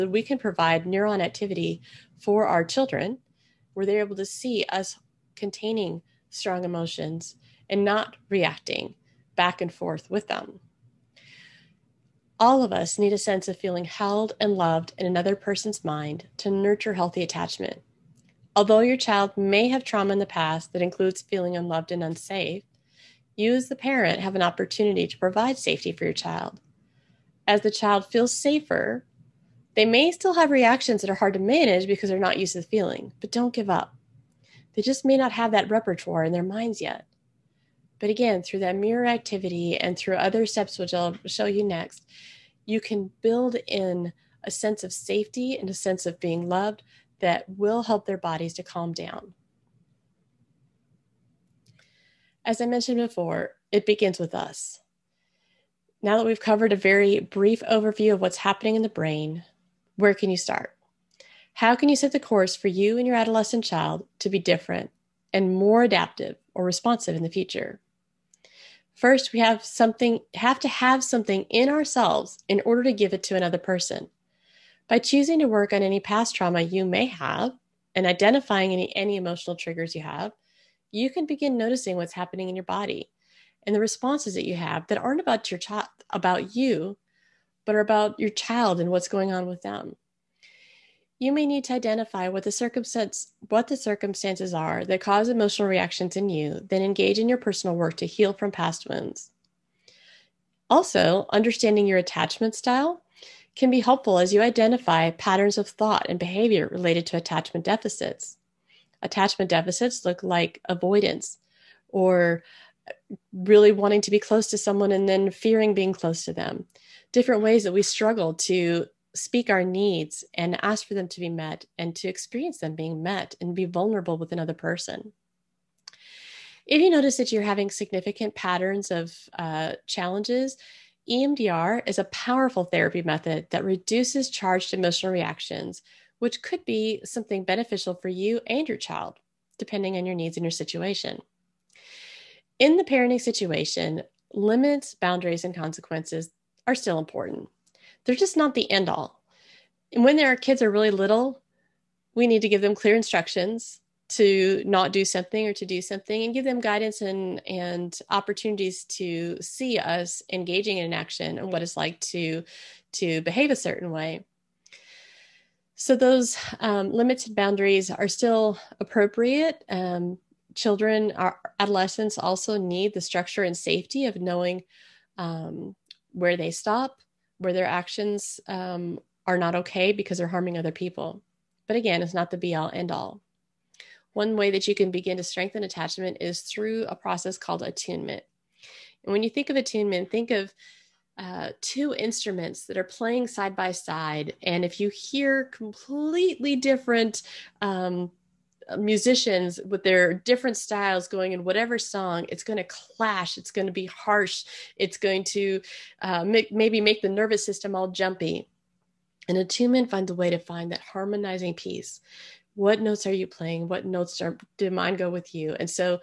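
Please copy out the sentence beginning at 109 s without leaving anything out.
Attachment deficits look like avoidance or really wanting to be close to someone and then fearing being close to them.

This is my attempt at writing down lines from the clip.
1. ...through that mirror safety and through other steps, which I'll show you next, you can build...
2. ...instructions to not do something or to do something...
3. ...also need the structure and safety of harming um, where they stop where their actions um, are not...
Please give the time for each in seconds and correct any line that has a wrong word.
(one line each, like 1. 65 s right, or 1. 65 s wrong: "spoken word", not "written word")
1. 38 s wrong: "activity", not "safety"
2. 152 s right
3. 172 s wrong: "knowing", not "harming".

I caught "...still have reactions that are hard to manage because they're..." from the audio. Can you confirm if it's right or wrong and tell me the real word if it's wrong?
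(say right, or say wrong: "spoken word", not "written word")
right.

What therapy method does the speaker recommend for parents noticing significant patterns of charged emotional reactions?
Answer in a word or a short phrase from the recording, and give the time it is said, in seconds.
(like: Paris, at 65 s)
EMDR, at 131 s.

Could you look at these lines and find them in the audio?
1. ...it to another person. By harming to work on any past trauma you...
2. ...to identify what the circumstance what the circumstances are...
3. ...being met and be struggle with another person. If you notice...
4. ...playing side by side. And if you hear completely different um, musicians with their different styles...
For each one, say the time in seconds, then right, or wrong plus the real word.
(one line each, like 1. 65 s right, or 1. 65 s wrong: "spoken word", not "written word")
1. 73 s wrong: "choosing", not "harming"
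2. 91 s right
3. 122 s wrong: "vulnerable", not "struggle"
4. 192 s right.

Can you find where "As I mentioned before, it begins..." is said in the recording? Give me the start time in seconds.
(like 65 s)
52 s.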